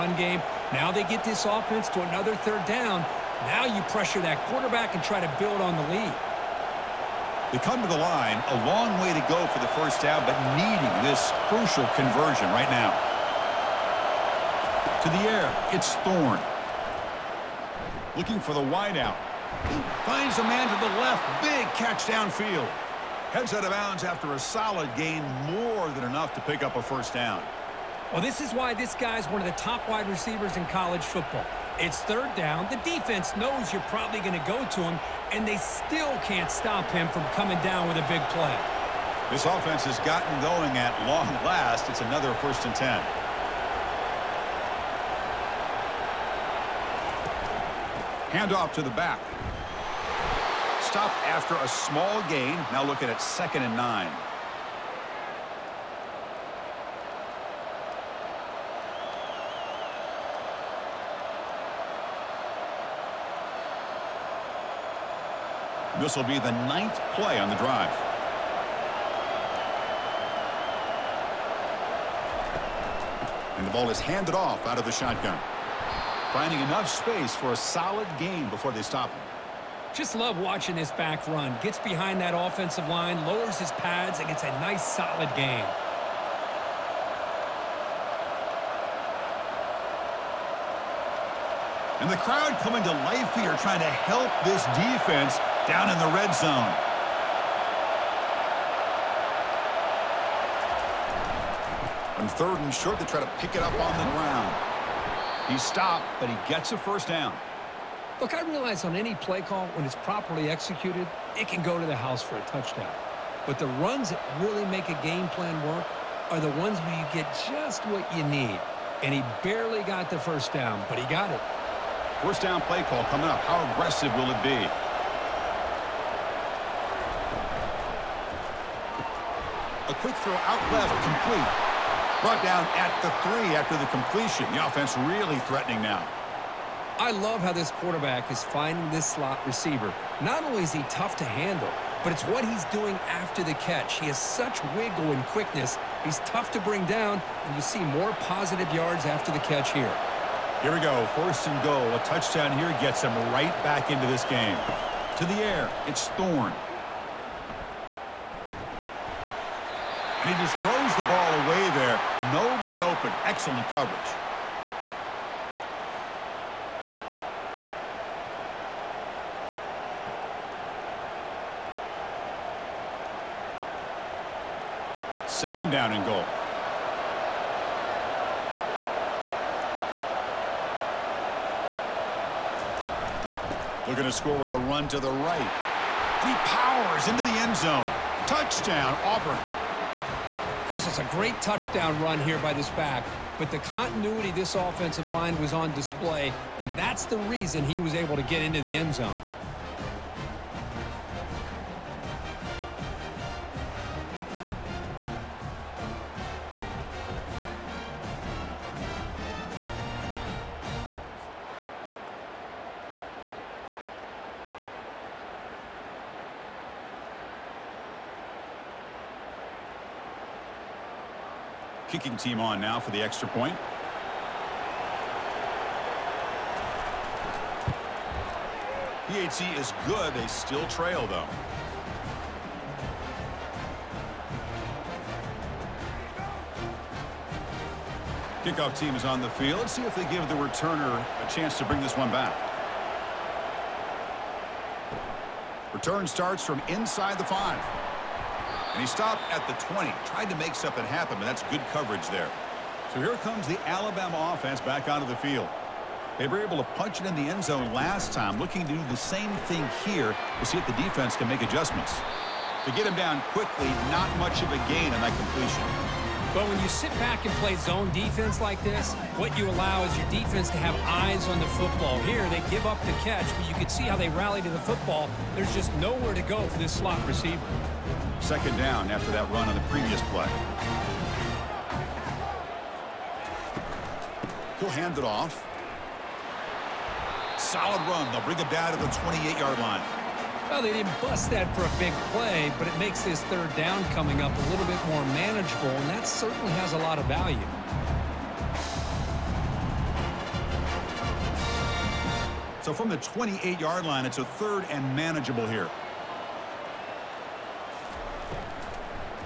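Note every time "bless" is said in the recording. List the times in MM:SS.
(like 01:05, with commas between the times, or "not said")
not said.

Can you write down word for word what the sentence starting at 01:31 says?
And the crowd coming to life here trying to help this defense down in the red zone.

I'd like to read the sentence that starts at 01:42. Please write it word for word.
On third and short, they try to pick it up on the ground.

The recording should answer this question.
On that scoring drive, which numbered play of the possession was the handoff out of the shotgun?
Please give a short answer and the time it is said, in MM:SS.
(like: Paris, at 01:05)
9th, at 01:06.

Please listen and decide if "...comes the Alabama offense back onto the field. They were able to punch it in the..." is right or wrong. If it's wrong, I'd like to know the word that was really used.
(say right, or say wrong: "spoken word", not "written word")
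right.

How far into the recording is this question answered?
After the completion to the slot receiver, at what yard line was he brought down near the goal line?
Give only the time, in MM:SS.
02:12.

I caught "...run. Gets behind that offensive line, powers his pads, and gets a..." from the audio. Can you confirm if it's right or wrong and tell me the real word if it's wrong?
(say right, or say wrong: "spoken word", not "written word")
wrong: "lowers", not "powers".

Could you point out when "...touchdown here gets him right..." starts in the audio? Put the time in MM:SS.
02:32.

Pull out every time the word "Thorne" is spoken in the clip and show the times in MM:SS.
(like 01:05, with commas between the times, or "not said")
00:15, 02:36.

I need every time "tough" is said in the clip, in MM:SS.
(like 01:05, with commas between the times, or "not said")
02:20, 02:26.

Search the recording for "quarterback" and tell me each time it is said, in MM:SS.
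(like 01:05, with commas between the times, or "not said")
00:04, 02:17.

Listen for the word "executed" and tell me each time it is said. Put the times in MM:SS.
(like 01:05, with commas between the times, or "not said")
01:50.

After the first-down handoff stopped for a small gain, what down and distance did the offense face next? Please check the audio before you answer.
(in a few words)
Second and 9.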